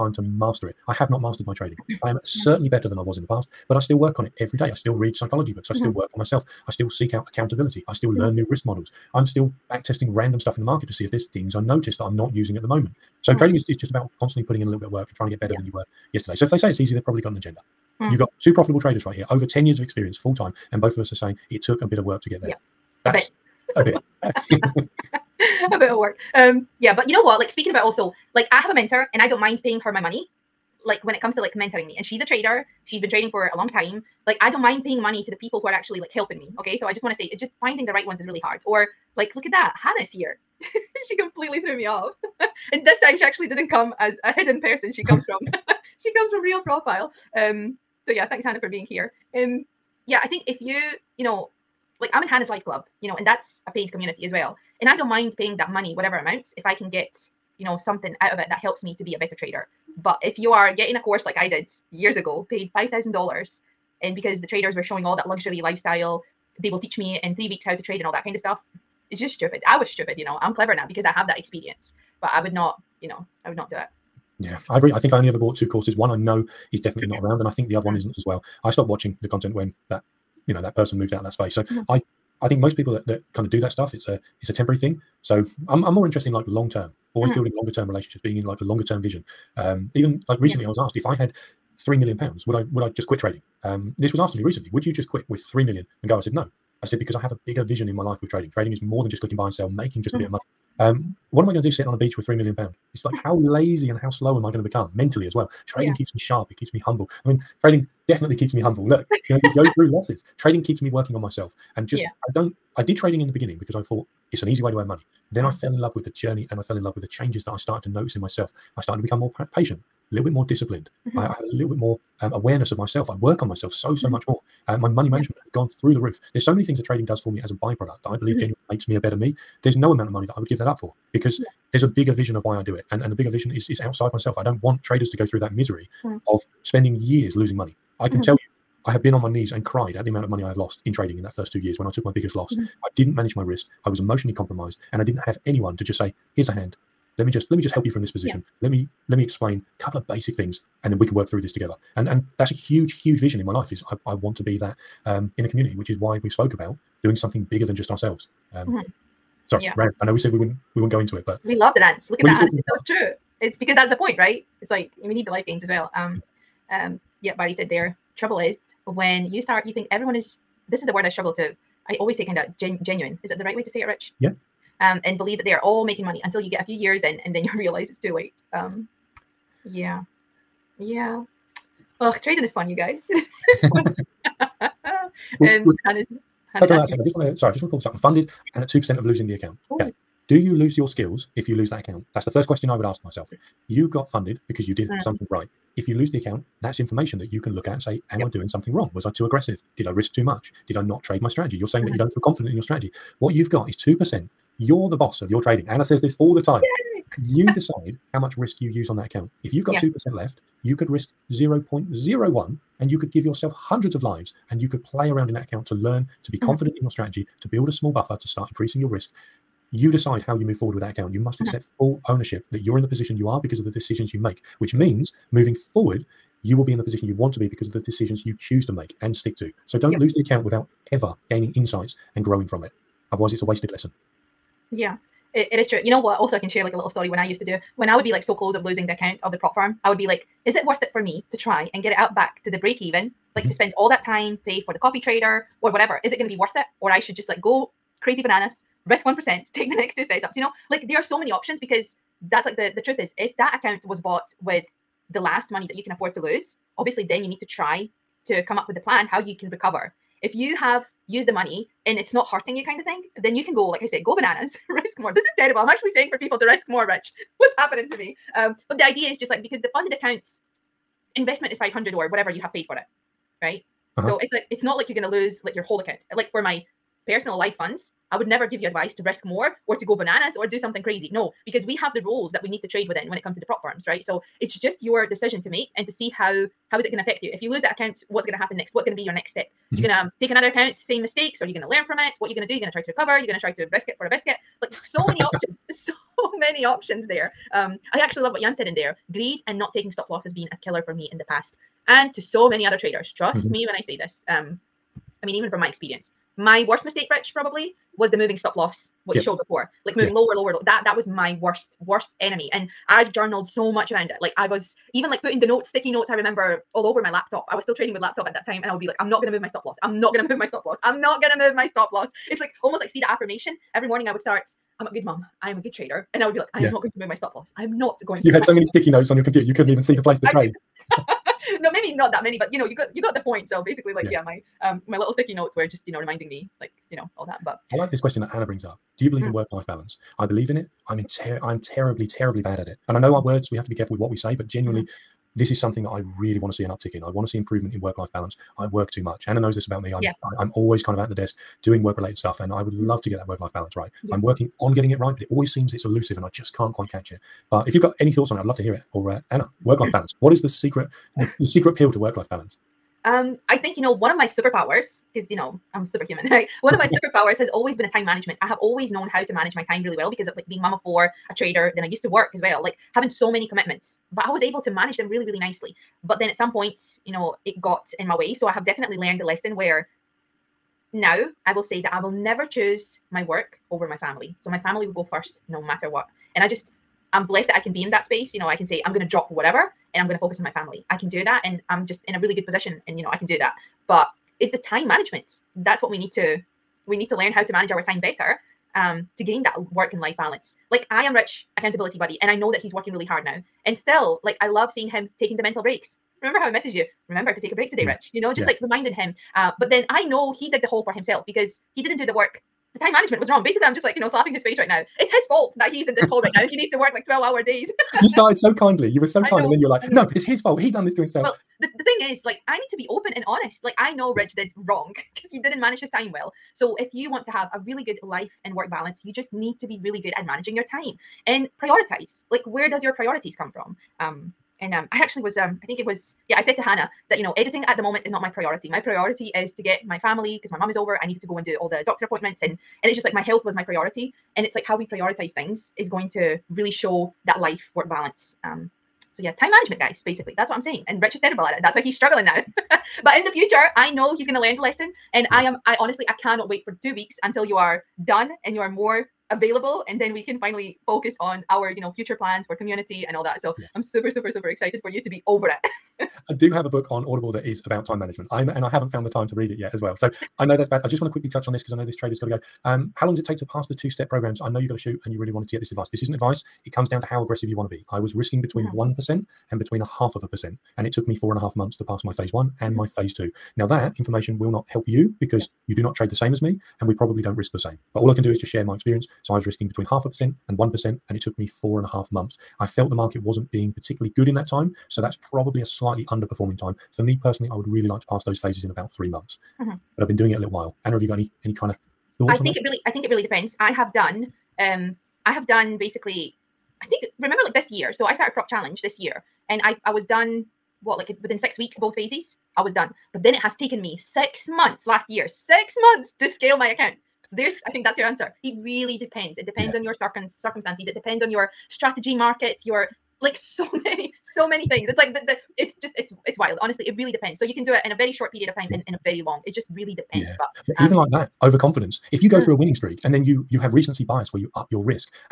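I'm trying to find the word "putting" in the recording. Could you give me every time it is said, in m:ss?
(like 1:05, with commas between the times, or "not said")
0:14, 5:15.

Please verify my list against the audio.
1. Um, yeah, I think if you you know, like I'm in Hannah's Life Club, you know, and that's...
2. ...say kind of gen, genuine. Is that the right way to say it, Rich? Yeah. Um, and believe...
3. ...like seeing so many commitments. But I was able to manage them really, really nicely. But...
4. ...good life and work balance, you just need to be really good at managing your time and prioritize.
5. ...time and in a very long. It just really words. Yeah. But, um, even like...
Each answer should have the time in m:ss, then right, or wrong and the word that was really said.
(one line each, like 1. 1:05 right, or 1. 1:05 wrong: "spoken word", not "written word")
1. 0:49 right
2. 2:52 right
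3. 6:12 wrong: "having", not "seeing"
4. 7:07 right
5. 8:48 wrong: "depends", not "words".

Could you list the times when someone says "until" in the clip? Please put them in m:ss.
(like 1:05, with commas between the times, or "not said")
2:56, 7:37.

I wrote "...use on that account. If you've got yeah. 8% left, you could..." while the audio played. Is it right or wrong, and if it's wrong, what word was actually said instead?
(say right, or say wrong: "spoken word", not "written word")
wrong: "2", not "8".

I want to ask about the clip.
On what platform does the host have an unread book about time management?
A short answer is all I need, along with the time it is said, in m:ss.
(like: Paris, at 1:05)
Audible, at 7:47.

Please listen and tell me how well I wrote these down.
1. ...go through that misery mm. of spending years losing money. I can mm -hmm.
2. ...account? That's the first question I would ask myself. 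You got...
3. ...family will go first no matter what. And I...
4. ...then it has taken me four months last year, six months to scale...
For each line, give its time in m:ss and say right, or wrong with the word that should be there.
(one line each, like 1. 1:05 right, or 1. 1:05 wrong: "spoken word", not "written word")
1. 2:15 right
2. 3:11 right
3. 6:24 right
4. 8:33 wrong: "six", not "four".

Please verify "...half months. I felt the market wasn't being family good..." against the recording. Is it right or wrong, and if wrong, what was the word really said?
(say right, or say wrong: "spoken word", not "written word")
wrong: "particularly", not "family".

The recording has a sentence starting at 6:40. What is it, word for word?
Like I am Rich accountability buddy, and I know that he's working really hard now.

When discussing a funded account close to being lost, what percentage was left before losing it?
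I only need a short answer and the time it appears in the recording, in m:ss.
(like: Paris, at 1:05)
2%, at 3:08.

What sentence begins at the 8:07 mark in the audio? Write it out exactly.
But all I can do is just share my experience.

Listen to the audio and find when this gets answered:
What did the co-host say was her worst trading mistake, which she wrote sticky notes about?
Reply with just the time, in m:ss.
5:08.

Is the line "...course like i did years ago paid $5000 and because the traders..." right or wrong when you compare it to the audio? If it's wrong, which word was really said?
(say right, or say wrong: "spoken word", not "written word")
right.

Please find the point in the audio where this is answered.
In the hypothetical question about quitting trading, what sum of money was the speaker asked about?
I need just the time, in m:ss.
1:31.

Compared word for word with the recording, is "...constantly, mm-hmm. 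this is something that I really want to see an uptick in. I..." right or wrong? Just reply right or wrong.
wrong.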